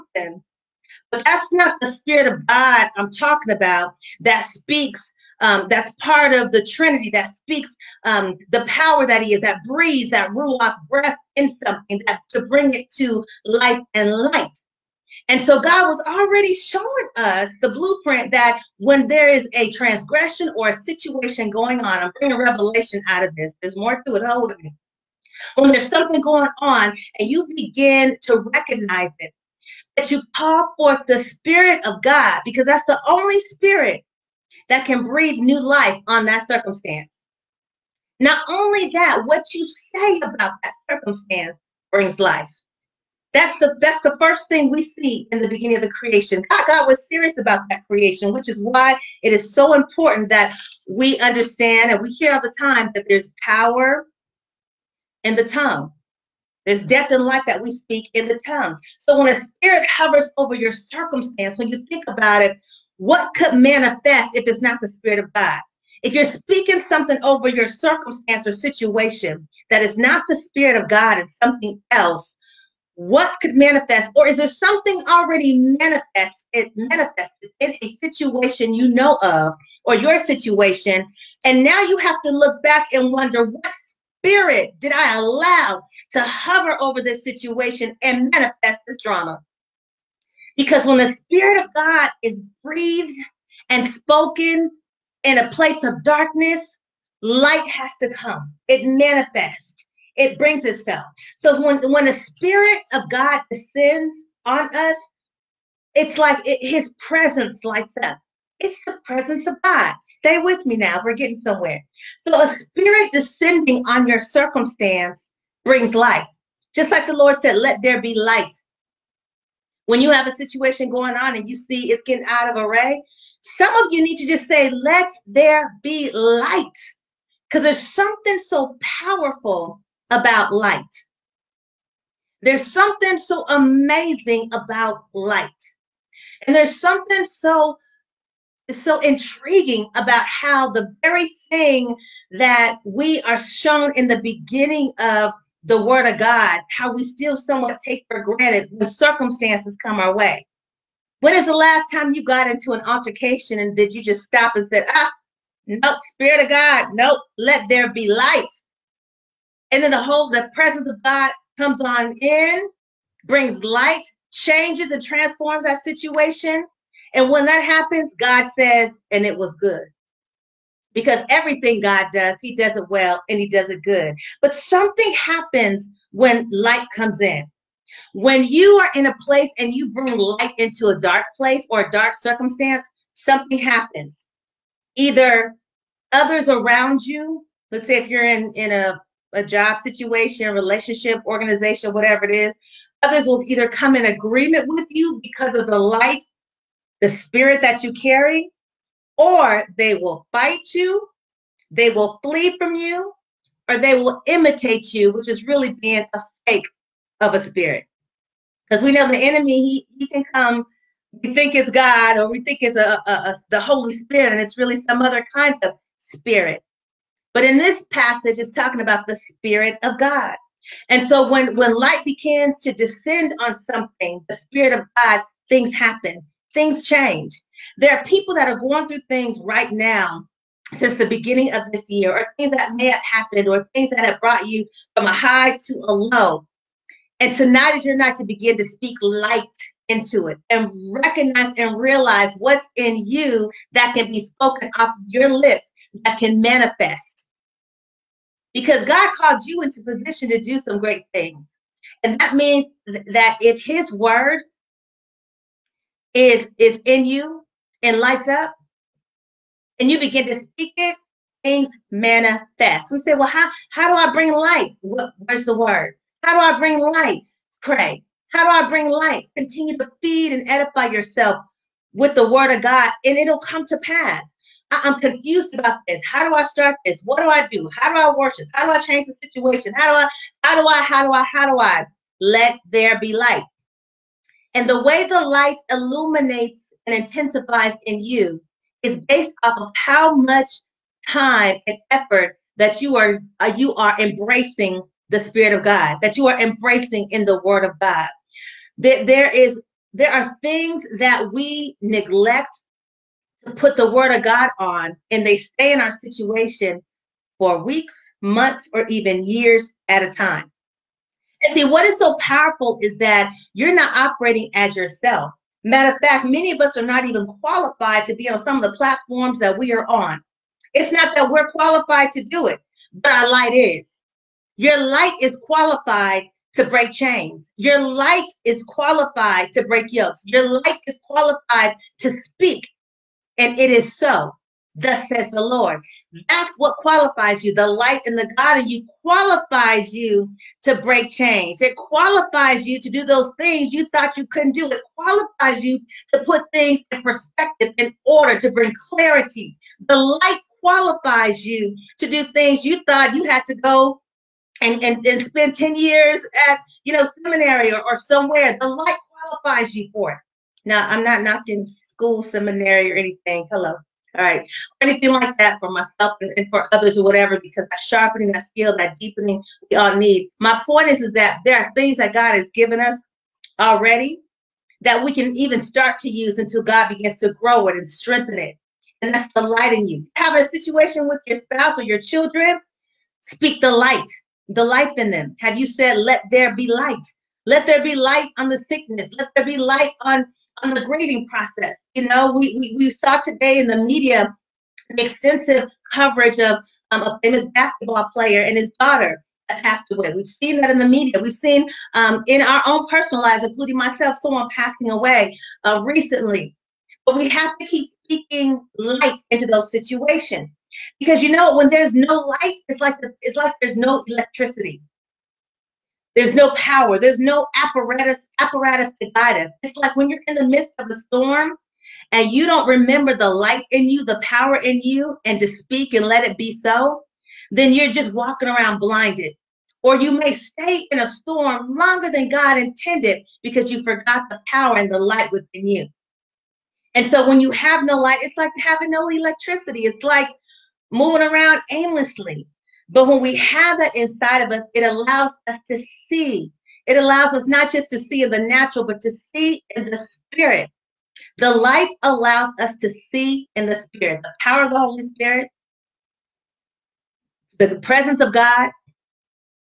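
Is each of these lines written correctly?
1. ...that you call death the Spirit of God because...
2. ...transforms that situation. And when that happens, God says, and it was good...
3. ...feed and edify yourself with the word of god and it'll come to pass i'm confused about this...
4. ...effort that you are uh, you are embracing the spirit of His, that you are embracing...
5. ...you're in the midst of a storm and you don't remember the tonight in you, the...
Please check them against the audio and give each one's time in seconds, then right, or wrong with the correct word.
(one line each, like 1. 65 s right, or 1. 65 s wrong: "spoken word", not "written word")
1. 29 s wrong: "forth", not "death"
2. 165 s right
3. 270 s right
4. 291 s wrong: "God", not "His"
5. 420 s wrong: "light", not "tonight".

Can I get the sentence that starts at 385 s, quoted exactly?
Have you said, let there be light?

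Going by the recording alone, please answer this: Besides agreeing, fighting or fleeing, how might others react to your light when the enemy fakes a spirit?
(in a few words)
imitate you.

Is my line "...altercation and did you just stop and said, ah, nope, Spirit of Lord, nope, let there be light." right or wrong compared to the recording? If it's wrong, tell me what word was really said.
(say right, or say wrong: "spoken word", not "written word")
wrong: "God", not "Lord".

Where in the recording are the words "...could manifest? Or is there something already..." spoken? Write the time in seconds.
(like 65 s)
73 s.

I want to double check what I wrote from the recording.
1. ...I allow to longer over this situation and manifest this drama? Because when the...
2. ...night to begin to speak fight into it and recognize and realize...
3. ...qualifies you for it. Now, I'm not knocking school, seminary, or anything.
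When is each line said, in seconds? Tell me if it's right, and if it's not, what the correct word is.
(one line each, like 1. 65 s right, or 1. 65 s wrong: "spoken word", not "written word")
1. 84 s wrong: "hover", not "longer"
2. 237 s wrong: "light", not "fight"
3. 359 s right.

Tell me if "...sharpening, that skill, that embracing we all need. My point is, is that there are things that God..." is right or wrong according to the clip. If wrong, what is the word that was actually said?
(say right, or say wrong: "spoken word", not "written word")
wrong: "deepening", not "embracing".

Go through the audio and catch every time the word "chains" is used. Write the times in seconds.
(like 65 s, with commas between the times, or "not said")
326 s, 341 s.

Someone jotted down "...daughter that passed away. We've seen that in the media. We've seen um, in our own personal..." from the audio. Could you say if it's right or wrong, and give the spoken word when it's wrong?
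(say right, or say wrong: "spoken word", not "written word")
right.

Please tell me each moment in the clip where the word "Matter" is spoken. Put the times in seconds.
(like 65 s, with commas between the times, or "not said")
315 s.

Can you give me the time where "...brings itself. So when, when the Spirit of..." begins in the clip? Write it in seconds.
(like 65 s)
100 s.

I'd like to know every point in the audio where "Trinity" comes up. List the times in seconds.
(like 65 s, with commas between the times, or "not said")
6 s.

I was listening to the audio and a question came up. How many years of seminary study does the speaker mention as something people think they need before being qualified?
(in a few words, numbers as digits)
10.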